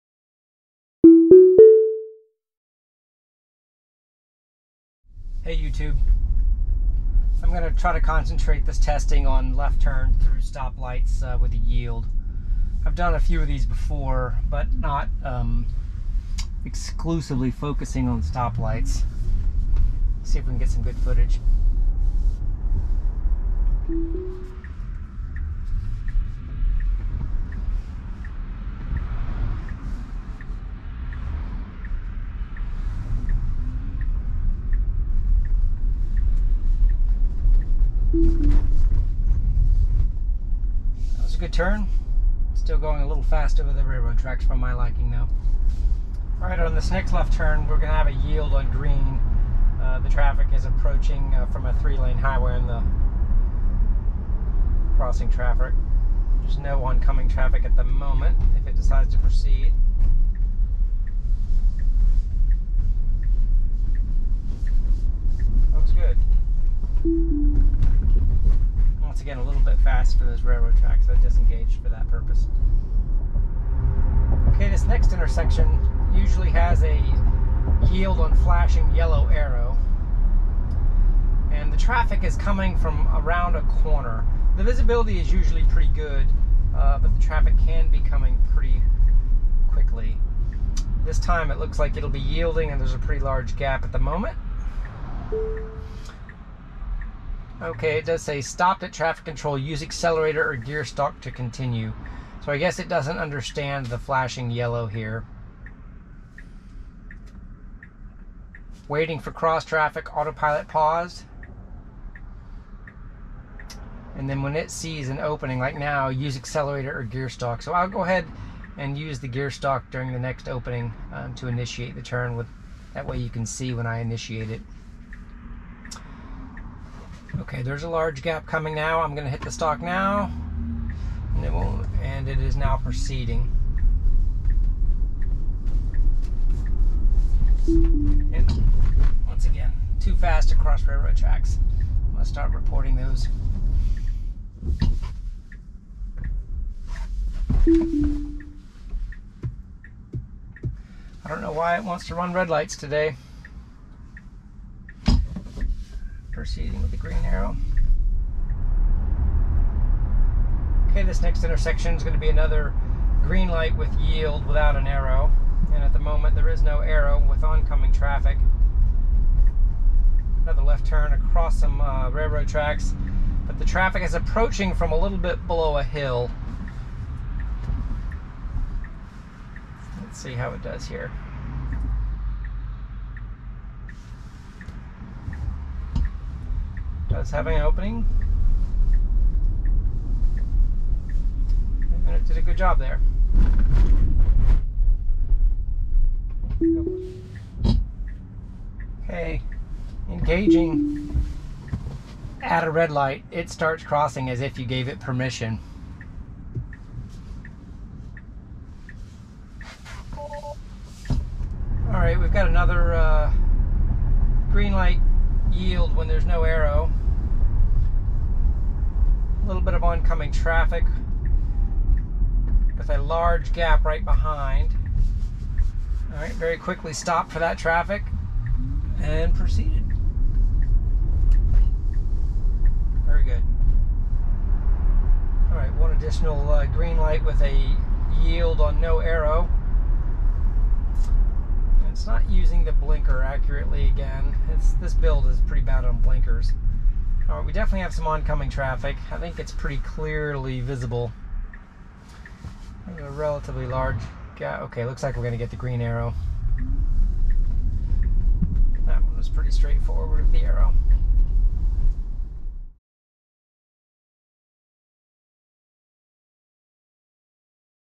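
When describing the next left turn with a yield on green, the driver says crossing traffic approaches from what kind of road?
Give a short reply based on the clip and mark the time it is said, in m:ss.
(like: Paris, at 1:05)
three-lane highway, at 0:51.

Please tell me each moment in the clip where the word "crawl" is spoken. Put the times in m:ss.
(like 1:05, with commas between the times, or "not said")
not said.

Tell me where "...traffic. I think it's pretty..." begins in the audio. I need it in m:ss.
4:08.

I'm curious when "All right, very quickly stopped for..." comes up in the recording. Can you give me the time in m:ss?
3:46.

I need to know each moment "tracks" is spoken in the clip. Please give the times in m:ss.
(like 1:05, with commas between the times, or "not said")
0:44, 1:10, 2:21, 2:52.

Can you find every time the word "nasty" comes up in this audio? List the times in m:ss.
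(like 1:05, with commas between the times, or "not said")
not said.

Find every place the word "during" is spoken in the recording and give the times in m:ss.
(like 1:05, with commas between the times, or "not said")
1:59.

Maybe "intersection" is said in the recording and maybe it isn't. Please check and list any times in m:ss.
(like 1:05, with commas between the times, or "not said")
1:15, 2:41.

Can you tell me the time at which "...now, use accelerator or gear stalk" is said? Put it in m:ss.
1:55.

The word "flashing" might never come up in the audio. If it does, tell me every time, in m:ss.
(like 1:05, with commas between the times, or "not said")
1:18, 1:43.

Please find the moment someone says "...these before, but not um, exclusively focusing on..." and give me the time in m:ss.
0:13.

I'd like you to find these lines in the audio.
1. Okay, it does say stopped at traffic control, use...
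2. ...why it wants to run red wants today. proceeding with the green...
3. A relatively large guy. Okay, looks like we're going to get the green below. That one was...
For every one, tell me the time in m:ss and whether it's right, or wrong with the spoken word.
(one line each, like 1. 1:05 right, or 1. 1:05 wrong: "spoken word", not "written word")
1. 1:37 right
2. 2:31 wrong: "lights", not "wants"
3. 4:12 wrong: "arrow", not "below".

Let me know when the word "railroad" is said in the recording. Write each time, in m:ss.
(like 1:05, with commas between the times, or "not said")
0:43, 1:10, 2:20, 2:52.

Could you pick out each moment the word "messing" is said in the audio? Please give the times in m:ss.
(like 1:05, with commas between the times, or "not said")
not said.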